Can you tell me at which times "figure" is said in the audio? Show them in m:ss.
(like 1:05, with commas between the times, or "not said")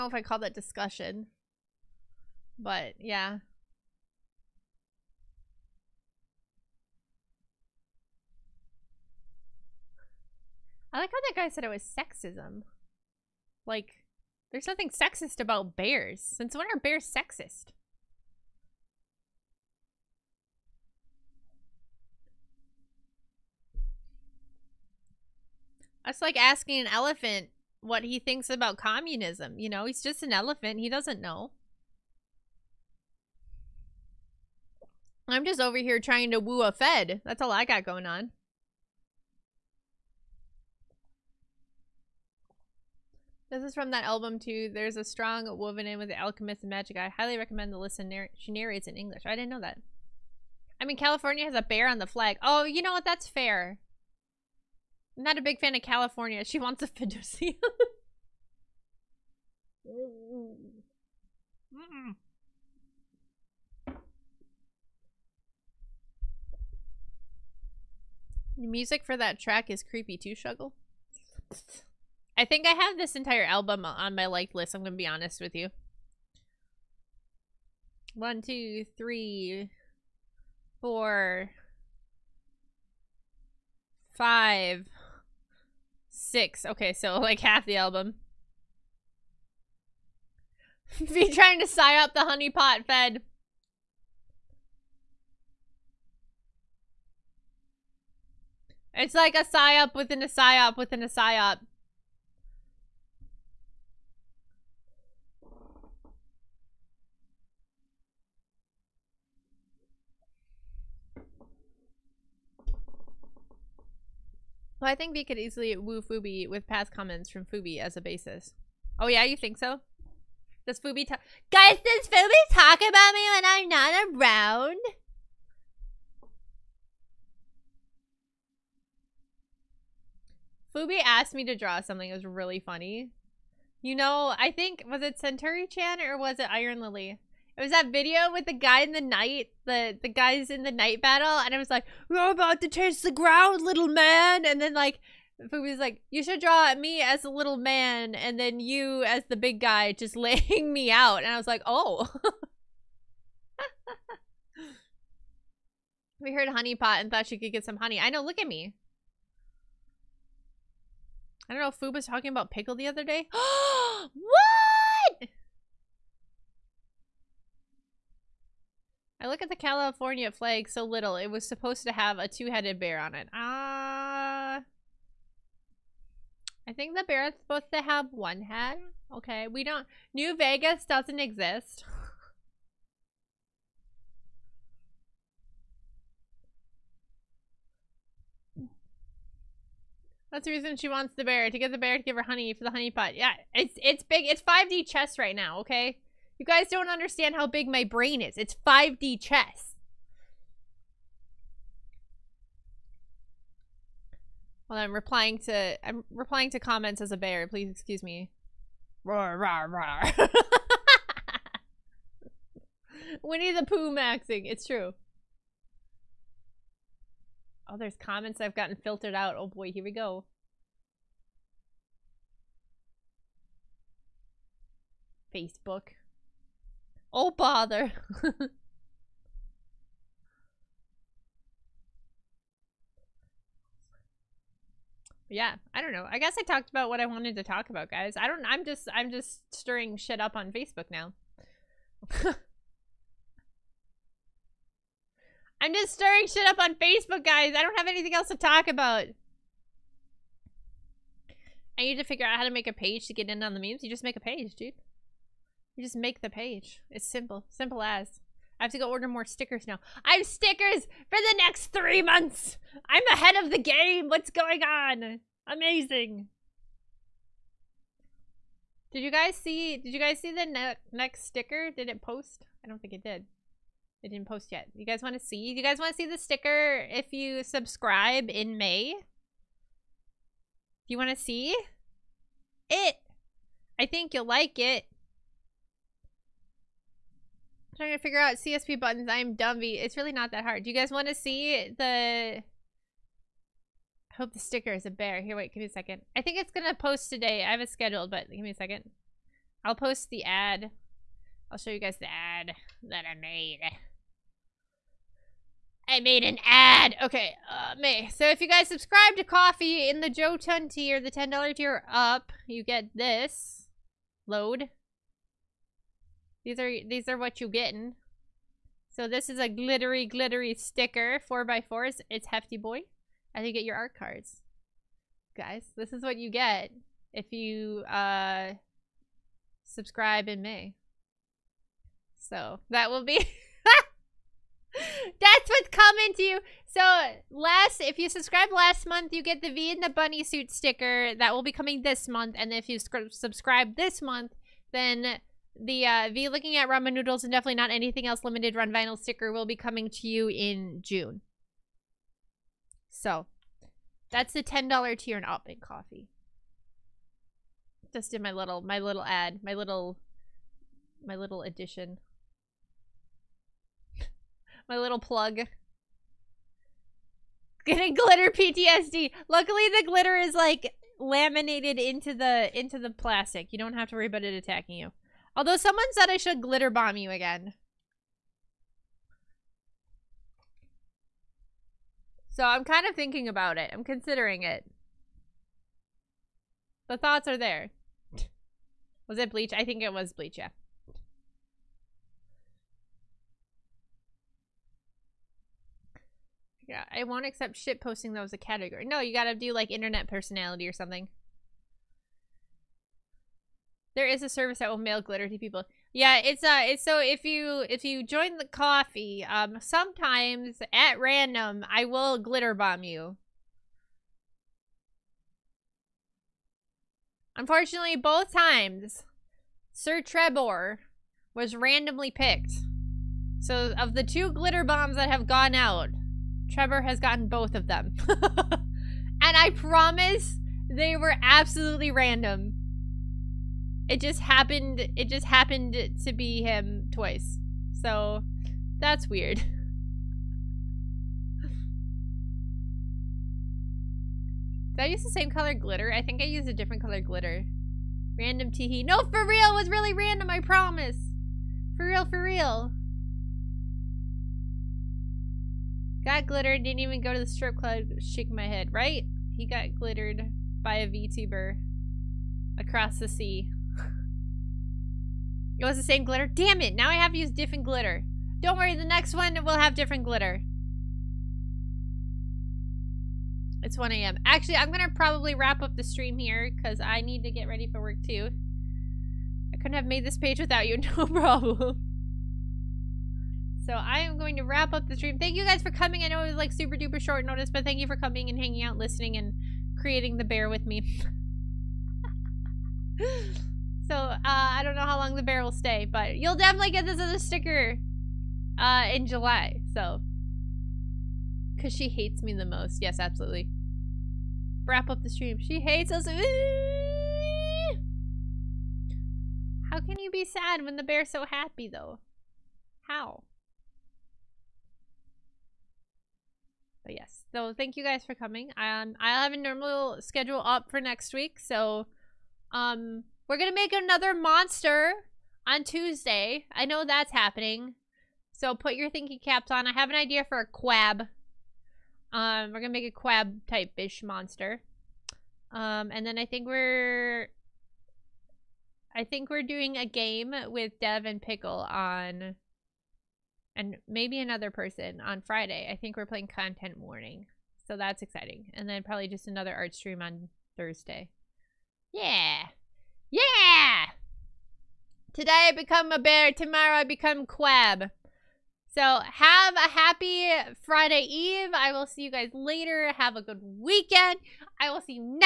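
4:12, 4:47.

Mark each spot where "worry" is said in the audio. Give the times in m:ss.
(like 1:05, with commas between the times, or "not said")
6:13, 7:48.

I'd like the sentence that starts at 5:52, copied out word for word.
So that's the $10 tier in up Ko-fi.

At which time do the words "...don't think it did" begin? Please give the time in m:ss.
4:32.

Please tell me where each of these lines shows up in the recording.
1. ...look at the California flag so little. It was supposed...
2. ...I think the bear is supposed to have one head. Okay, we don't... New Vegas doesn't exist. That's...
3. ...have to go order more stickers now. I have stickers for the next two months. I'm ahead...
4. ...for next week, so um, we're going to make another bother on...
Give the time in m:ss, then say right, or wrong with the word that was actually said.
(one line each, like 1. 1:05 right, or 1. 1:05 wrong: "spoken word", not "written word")
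1. 2:49 right
2. 2:56 right
3. 4:18 wrong: "three", not "two"
4. 8:40 wrong: "monster", not "bother".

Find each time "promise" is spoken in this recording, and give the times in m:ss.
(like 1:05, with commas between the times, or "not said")
7:09, 7:30.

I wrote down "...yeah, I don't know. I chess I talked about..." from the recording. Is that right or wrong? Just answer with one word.
wrong.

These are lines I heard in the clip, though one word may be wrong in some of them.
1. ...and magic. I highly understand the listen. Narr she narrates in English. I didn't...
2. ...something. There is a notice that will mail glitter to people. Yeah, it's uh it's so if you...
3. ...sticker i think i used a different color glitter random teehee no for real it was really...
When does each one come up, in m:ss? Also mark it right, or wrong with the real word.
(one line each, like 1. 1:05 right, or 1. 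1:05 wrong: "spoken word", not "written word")
1. 0:46 wrong: "recommend", not "understand"
2. 6:40 wrong: "service", not "notice"
3. 7:25 wrong: "glitter", not "sticker".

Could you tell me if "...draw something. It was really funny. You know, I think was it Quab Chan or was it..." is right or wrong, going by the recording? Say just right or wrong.
wrong.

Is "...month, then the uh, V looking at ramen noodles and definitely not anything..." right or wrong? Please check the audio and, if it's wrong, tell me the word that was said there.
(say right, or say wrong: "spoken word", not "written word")
right.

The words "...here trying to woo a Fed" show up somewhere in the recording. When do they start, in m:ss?
0:35.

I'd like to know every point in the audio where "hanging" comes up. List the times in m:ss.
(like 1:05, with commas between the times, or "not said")
8:08.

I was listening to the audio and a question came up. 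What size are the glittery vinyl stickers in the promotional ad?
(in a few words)
4x4.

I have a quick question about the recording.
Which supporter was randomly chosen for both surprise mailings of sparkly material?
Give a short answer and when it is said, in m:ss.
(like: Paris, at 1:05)
Sir Trebor, at 6:59.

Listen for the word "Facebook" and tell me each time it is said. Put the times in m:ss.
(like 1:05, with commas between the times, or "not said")
3:45, 4:00, 4:06.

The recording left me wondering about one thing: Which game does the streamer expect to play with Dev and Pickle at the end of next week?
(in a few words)
Content Warning.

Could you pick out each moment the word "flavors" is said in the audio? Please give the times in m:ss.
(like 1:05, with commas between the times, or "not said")
not said.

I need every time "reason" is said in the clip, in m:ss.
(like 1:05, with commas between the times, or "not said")
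3:10.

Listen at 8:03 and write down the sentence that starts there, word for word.
So I am going to wrap up the stream.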